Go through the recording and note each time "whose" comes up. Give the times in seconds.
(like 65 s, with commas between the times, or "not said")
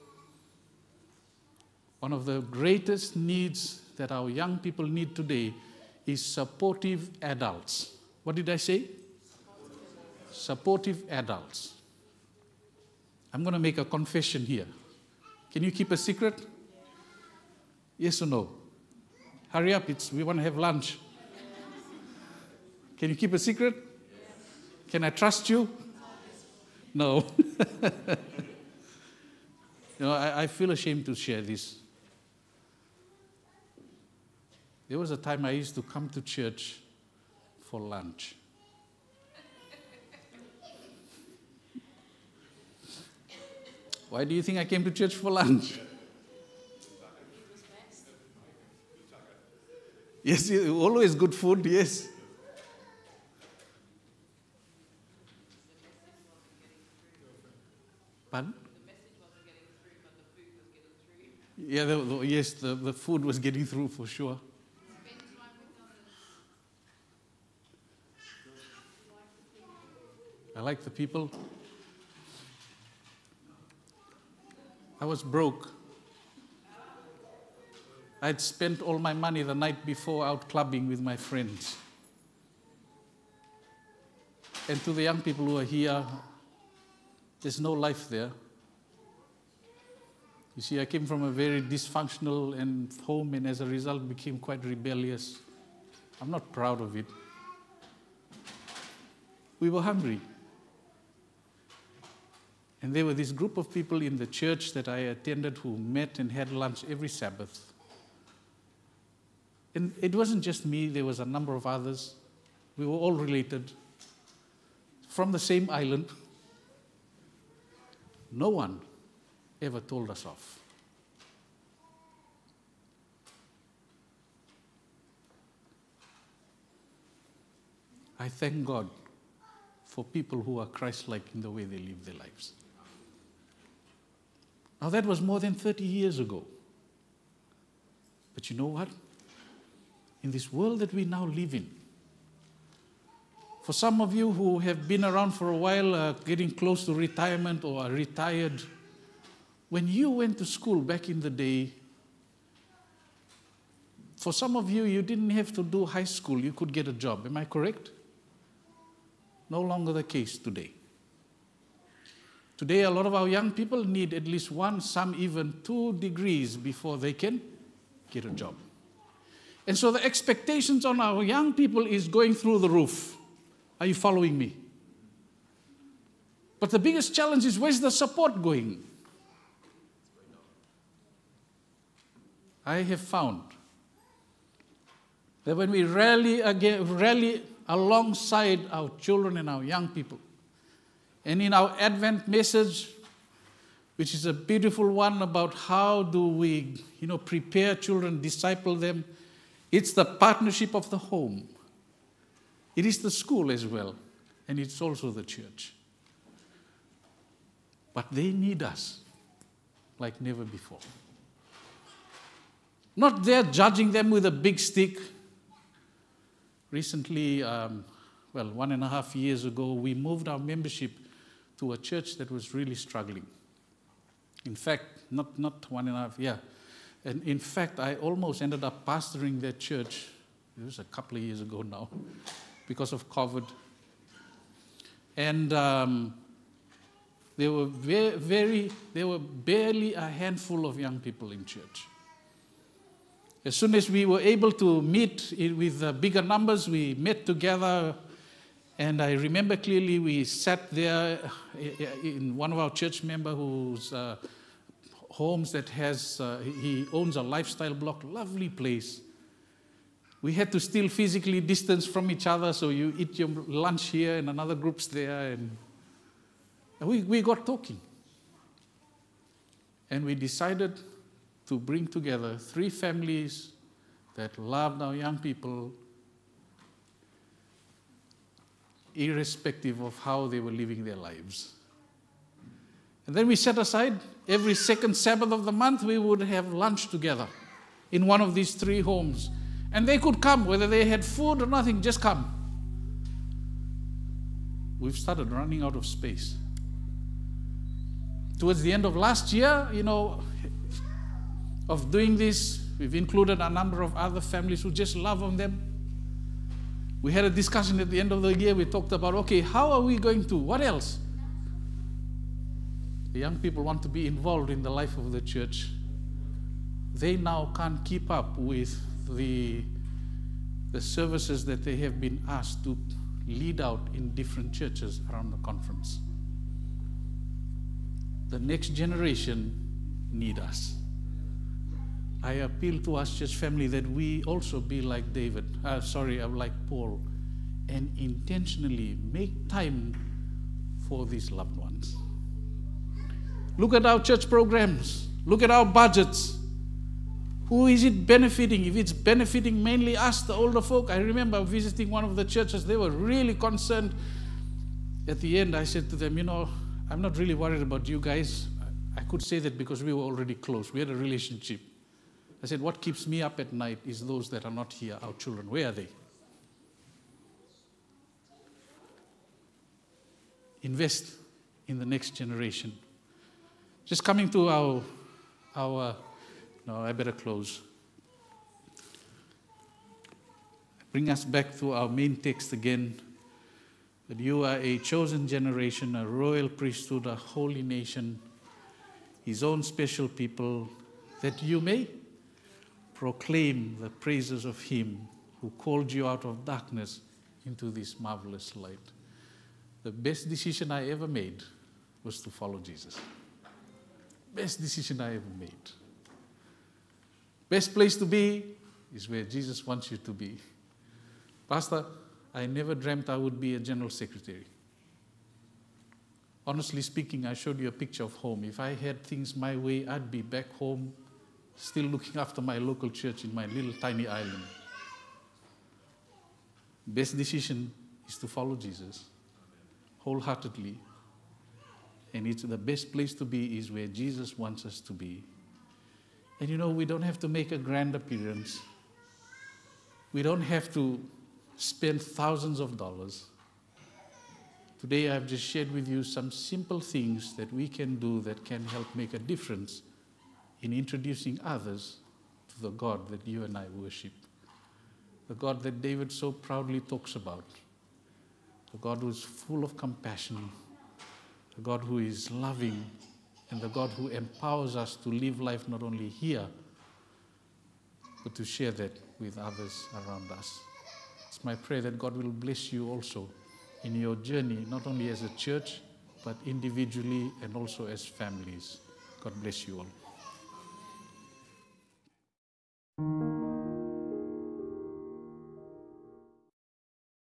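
253 s.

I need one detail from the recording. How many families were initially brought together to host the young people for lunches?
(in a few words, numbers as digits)
3.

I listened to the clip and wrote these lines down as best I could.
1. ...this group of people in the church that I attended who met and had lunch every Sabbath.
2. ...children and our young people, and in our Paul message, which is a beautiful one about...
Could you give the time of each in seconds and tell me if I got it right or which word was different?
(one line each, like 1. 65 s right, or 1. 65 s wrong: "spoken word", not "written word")
1. 103 s right
2. 188 s wrong: "Advent", not "Paul".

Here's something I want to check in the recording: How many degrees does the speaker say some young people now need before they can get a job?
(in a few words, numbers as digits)
2.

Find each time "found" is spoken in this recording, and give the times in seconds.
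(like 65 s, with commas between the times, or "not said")
183 s.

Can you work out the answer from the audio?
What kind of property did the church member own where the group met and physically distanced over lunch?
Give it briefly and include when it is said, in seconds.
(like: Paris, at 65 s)
A lifestyle block, at 257 s.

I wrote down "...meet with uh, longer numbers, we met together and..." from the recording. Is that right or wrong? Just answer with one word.
wrong.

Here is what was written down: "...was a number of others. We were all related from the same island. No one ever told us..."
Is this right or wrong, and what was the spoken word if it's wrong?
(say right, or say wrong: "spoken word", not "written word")
right.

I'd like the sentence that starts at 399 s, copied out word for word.
The best decision I ever made was to follow Jesus.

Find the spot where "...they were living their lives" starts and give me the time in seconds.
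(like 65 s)
280 s.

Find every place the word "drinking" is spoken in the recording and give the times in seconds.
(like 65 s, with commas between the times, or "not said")
not said.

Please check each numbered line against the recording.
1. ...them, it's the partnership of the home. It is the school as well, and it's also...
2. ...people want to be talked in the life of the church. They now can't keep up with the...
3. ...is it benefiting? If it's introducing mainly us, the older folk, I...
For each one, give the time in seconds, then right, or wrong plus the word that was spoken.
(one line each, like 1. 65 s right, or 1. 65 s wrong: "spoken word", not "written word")
1. 198 s right
2. 313 s wrong: "involved", not "talked"
3. 347 s wrong: "benefiting", not "introducing".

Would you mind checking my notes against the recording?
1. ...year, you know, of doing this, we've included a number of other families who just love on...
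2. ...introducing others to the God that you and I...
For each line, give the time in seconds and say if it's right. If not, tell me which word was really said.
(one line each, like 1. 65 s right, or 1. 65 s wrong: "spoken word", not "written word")
1. 299 s right
2. 450 s right.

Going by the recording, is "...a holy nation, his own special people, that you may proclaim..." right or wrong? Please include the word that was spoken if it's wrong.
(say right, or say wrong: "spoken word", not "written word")
right.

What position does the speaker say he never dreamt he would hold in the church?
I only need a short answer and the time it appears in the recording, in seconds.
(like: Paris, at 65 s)
General secretary, at 413 s.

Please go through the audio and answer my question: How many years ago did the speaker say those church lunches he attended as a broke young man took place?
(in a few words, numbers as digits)
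More than 30.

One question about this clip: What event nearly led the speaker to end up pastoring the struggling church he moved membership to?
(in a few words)
COVID.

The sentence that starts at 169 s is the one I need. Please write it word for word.
And so the expectations on our young people is going through the roof.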